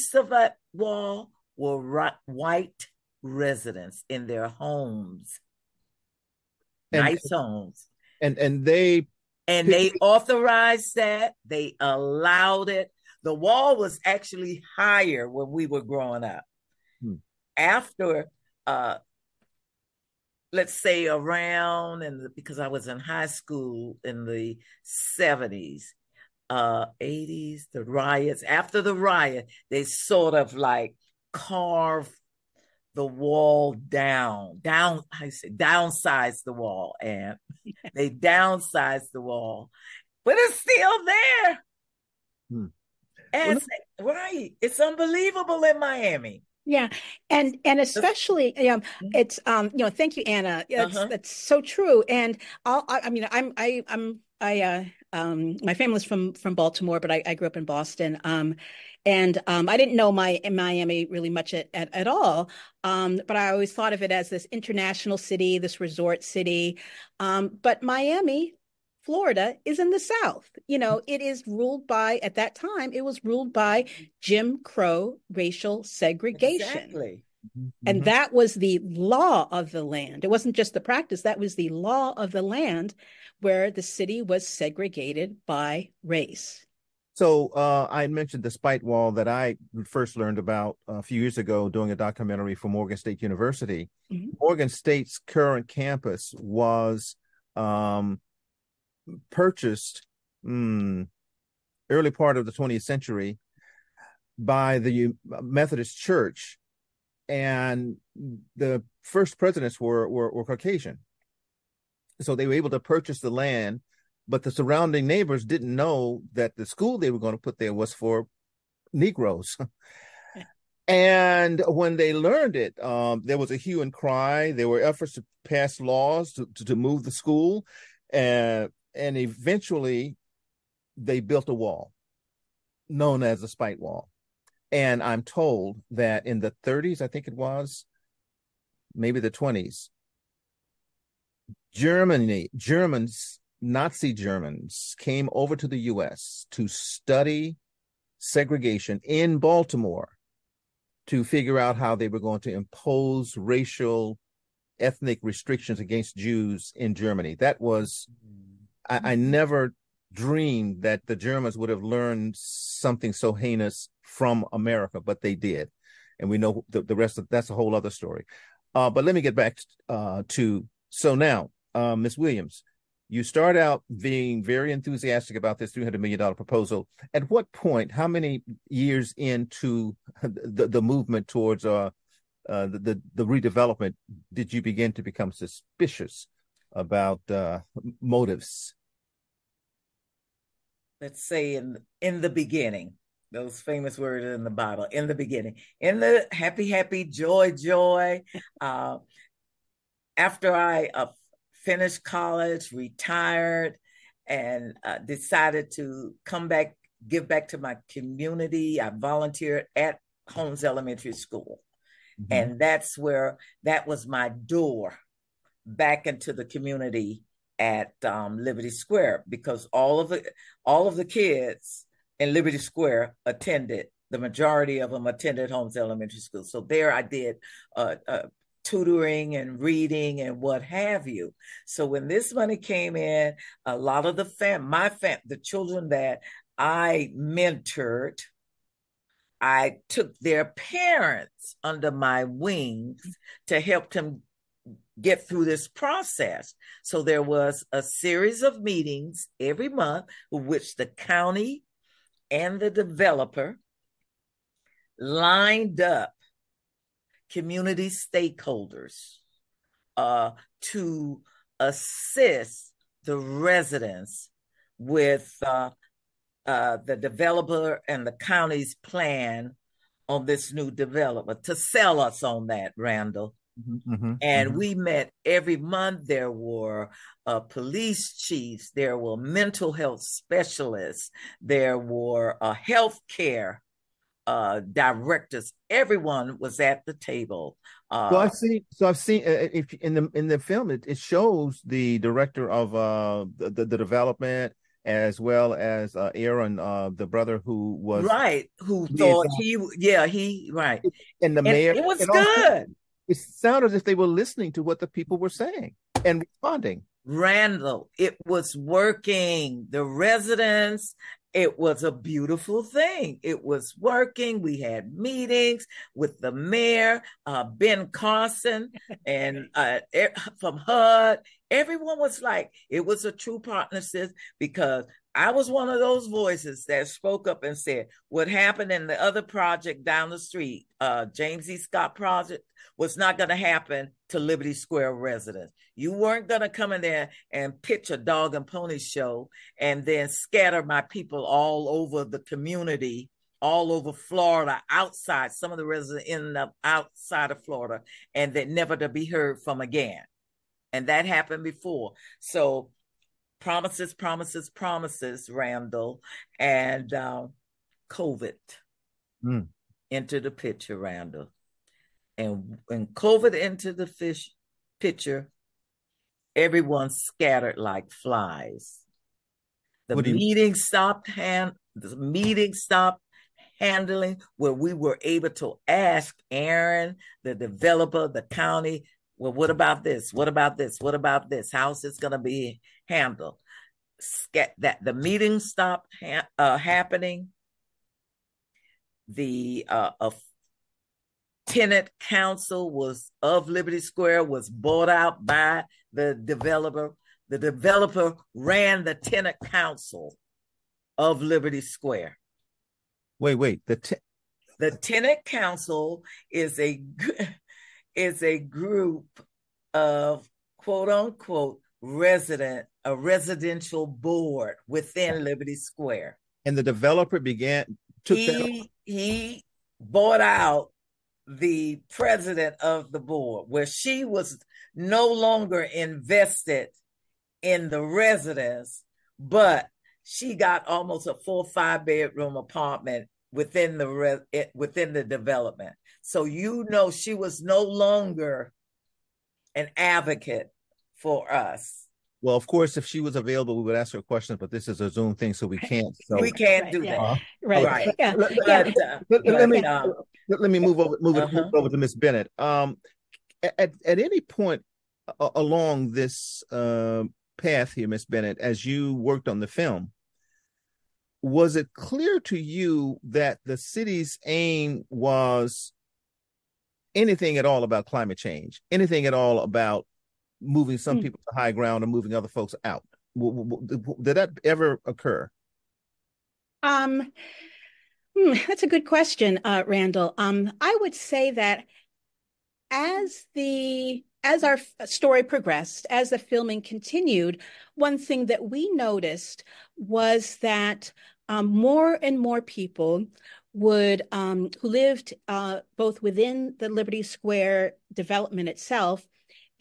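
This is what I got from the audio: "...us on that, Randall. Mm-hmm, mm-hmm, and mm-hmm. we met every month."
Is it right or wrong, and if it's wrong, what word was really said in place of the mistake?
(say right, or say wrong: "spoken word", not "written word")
right.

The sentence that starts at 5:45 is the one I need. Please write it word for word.
Some of the residents ended up outside of Florida and that never to be heard from again.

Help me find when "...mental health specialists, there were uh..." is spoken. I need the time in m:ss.
4:39.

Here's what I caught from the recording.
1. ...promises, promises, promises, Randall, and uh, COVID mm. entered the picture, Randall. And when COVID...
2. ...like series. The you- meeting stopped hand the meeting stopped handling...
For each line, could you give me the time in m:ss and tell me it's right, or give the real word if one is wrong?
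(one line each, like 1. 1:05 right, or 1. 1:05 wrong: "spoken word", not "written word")
1. 5:53 right
2. 6:07 wrong: "flies", not "series".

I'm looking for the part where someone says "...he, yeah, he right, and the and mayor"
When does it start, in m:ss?
4:59.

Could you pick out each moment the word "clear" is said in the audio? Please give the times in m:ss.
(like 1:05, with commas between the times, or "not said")
7:41.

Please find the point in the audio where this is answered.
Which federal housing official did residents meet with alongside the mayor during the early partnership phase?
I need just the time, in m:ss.
5:17.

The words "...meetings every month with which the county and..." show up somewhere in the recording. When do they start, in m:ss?
4:08.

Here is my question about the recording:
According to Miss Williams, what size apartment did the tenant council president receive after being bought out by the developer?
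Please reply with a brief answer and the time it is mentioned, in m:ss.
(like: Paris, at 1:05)
five bedroom, at 7:11.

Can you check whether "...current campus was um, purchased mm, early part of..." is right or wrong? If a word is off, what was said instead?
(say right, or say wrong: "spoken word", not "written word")
right.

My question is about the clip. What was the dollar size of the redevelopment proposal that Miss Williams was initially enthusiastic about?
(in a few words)
$300 million.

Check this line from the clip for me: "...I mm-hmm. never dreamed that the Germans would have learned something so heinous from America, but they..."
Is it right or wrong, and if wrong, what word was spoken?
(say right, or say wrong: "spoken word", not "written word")
right.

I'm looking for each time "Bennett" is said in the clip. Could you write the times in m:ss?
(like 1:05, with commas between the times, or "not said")
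7:31, 7:38.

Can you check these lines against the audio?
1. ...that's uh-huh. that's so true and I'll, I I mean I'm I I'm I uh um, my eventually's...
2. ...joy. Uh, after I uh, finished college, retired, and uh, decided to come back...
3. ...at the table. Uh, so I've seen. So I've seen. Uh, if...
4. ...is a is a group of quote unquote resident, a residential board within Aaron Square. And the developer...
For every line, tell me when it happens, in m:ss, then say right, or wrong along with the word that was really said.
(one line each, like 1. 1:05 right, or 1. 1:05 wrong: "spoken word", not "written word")
1. 0:50 wrong: "family", not "eventually"
2. 3:17 right
3. 4:46 right
4. 6:46 wrong: "Liberty", not "Aaron".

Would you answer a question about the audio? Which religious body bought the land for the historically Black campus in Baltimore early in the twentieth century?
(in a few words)
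the Methodist Church.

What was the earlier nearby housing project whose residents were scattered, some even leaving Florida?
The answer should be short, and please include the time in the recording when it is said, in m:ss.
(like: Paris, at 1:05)
James E. Scott, at 5:31.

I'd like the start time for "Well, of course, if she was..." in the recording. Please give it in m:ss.
7:22.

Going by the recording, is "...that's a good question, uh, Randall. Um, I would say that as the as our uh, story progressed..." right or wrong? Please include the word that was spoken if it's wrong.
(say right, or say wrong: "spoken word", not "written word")
right.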